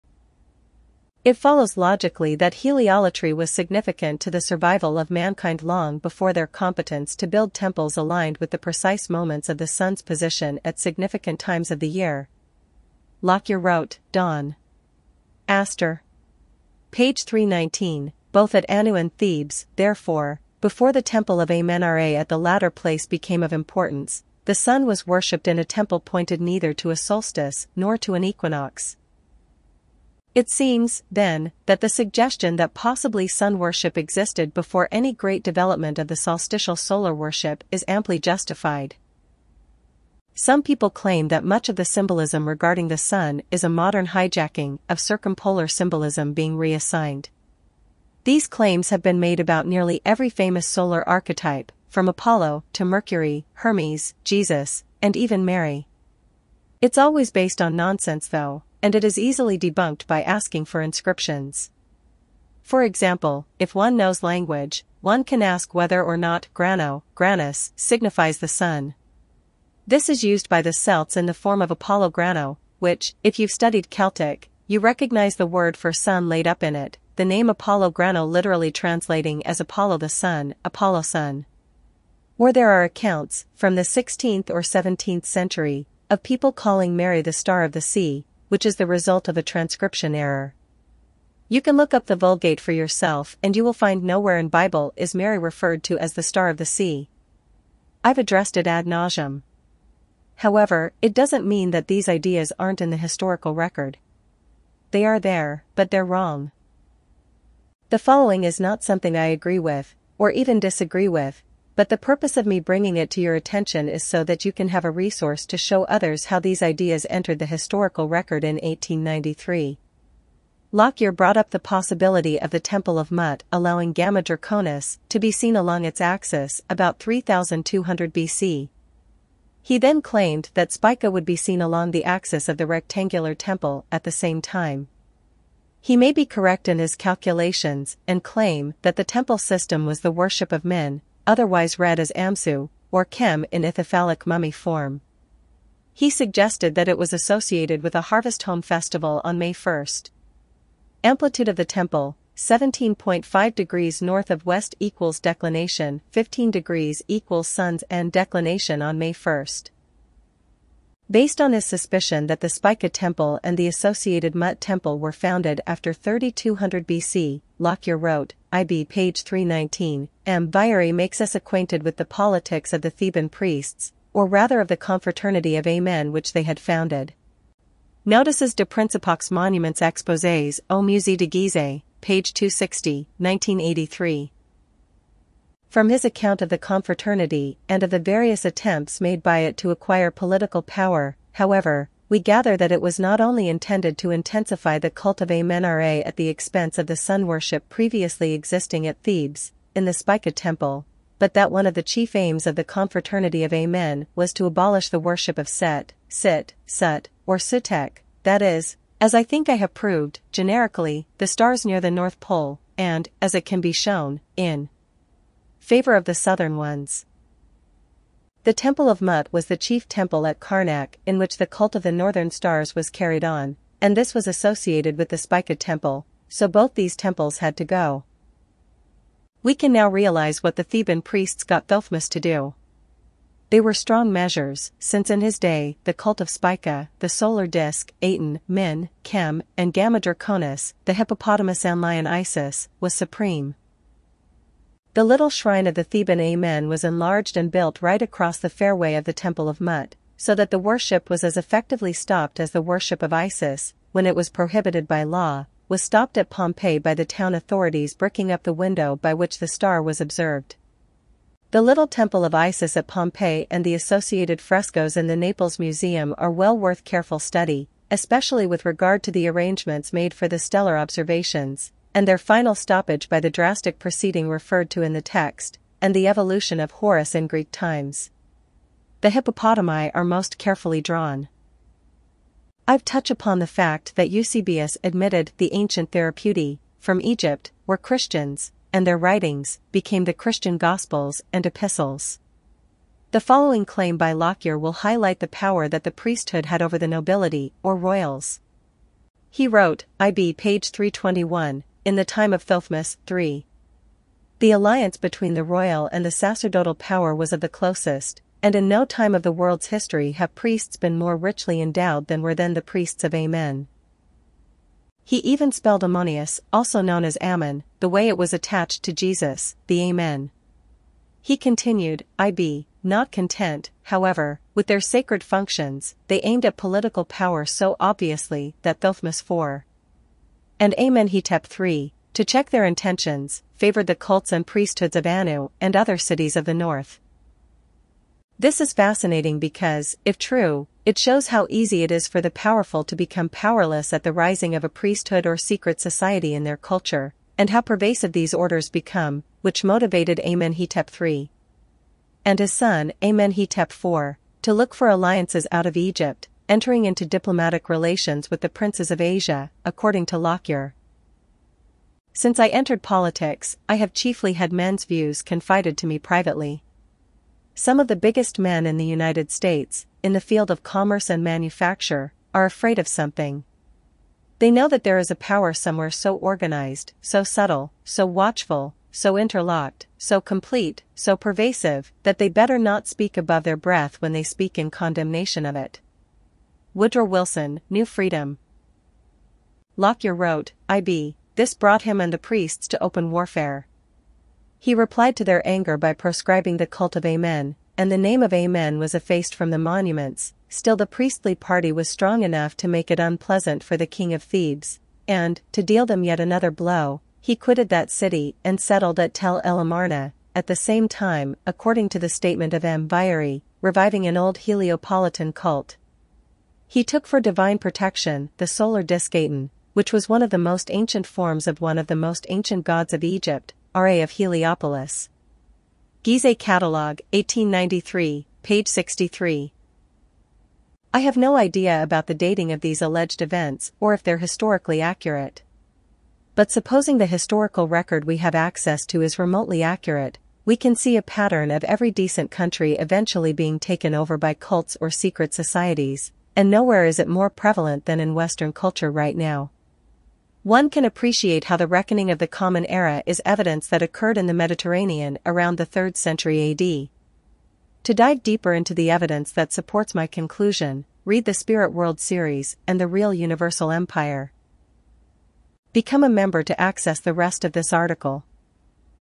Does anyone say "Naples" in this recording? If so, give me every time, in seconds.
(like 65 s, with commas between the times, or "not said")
265 s.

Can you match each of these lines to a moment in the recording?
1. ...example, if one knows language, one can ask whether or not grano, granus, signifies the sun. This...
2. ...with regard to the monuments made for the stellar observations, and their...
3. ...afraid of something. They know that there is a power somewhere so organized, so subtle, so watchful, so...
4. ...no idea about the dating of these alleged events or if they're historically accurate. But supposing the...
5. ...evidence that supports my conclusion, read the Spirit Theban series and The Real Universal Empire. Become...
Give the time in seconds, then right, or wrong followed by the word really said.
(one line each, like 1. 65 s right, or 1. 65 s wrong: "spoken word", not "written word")
1. 62 s right
2. 268 s wrong: "arrangements", not "monuments"
3. 372 s right
4. 431 s right
5. 458 s wrong: "Whirled", not "Theban".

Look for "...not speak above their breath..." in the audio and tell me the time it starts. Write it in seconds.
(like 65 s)
382 s.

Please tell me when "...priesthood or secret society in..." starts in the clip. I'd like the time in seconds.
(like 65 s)
344 s.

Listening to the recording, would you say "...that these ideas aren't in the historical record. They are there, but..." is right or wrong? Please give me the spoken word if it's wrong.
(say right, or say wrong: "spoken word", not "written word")
right.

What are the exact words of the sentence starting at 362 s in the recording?
Since I entered politics, I have chiefly had men's views confided to me privately.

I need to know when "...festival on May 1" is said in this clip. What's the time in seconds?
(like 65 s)
148 s.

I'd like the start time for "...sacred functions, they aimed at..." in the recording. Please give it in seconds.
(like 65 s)
324 s.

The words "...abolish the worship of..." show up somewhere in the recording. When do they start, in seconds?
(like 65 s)
204 s.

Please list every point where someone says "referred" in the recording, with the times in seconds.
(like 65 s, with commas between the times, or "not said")
95 s, 274 s.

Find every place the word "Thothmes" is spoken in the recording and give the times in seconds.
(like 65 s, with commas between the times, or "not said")
231 s, 302 s, 328 s.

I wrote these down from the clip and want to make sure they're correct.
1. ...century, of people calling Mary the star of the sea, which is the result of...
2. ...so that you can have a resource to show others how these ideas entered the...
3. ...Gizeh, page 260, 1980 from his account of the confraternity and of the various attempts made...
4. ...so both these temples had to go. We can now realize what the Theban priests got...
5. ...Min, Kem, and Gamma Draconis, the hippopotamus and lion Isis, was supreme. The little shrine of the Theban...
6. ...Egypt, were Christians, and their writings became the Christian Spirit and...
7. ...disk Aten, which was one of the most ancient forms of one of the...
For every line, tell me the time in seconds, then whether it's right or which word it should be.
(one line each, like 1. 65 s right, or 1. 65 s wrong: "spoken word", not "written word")
1. 85 s right
2. 114 s right
3. 181 s wrong: "1983", not "1980"
4. 226 s right
5. 238 s right
6. 287 s wrong: "Gospels", not "Spirit"
7. 418 s right.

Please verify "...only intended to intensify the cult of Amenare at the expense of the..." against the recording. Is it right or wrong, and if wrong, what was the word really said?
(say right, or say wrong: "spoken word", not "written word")
right.